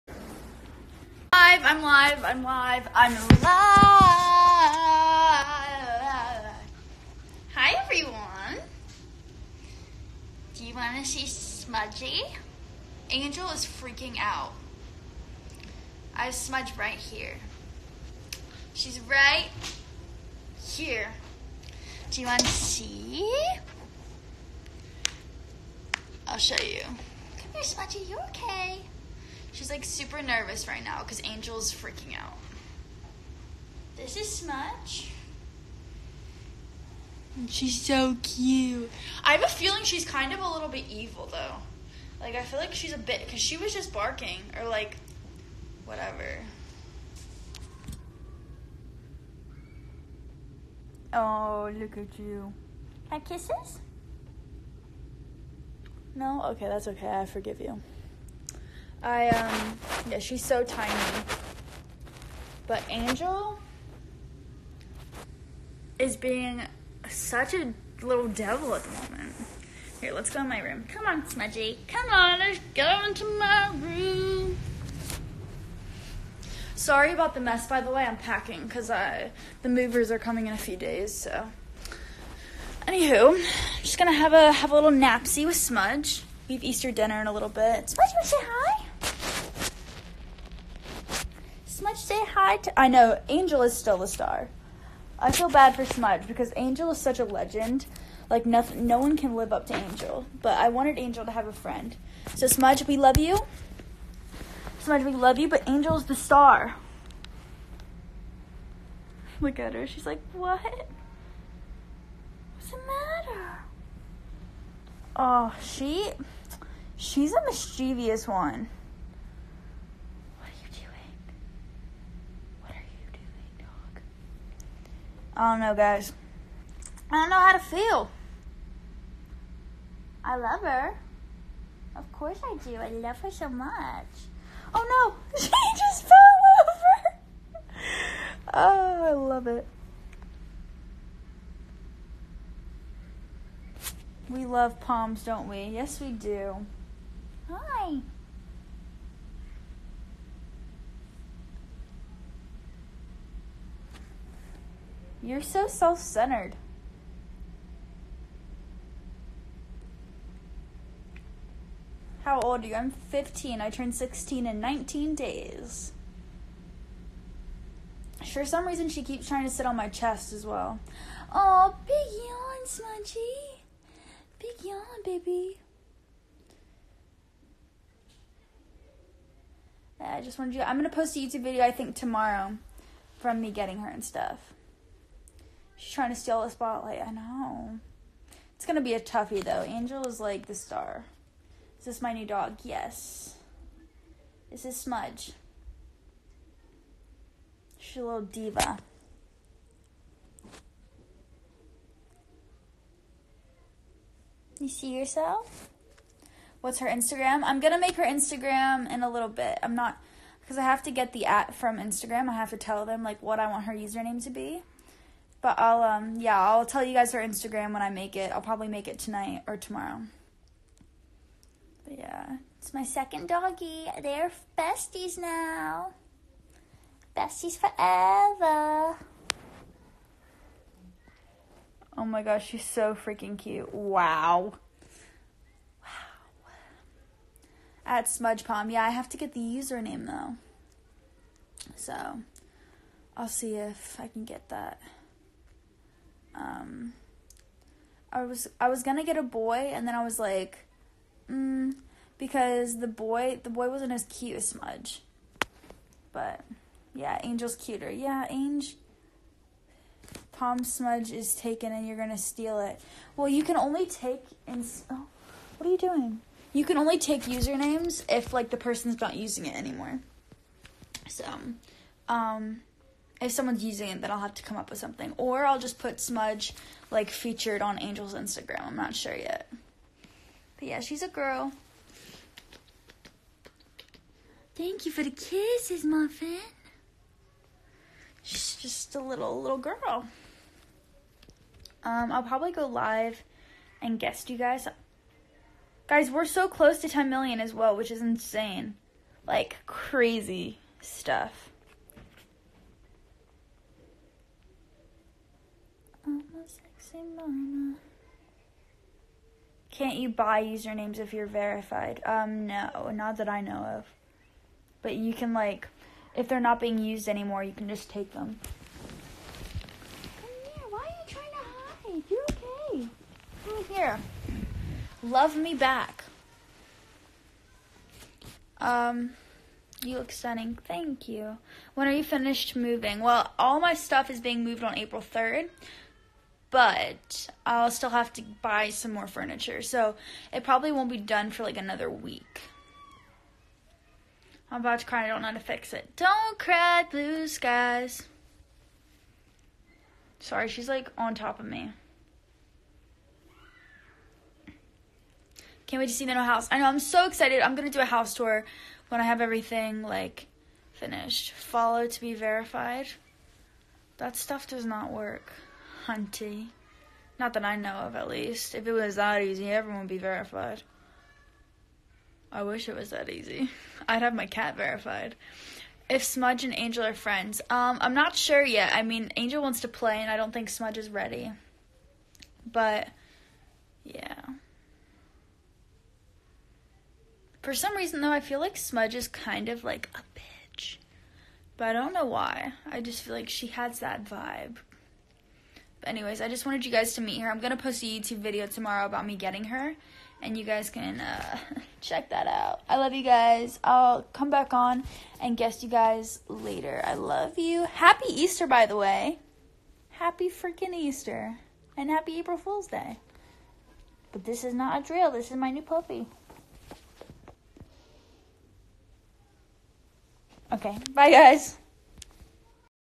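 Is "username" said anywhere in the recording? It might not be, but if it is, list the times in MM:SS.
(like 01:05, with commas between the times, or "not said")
03:33, 03:59, 04:27, 05:10.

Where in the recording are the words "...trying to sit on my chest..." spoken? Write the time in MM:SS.
02:49.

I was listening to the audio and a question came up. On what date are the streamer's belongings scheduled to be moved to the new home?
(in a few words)
April 3rd.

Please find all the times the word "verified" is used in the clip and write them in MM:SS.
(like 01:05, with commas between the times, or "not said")
05:11, 06:02, 06:09, 06:14.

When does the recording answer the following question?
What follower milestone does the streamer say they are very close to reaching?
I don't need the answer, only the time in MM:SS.
04:56.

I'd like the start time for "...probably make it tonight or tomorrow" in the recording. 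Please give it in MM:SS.
03:38.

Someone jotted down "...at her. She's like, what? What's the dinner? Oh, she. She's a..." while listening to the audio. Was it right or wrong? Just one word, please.
wrong.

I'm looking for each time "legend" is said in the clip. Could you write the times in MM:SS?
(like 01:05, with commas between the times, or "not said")
01:37.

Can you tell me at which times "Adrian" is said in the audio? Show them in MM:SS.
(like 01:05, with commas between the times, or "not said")
not said.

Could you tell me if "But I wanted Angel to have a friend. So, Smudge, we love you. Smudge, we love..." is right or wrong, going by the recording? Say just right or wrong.
right.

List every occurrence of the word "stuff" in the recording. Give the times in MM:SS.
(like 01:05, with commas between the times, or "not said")
03:04, 05:00, 05:33, 06:04.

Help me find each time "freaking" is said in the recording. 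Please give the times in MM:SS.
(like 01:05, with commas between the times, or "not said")
00:13, 00:31, 03:52, 06:50.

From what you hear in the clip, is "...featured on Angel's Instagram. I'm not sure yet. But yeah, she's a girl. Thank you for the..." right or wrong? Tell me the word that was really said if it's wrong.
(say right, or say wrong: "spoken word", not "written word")
right.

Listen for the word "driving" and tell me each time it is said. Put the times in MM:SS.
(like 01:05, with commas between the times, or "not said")
not said.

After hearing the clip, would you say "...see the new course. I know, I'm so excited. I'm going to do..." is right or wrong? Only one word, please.
wrong.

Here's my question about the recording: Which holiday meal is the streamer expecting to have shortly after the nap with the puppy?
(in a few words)
Easter dinner.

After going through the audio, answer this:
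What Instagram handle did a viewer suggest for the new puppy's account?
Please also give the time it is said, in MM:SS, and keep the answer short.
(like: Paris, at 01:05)
Smudge Palm, at 03:57.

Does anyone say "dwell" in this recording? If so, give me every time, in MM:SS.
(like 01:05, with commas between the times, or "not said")
not said.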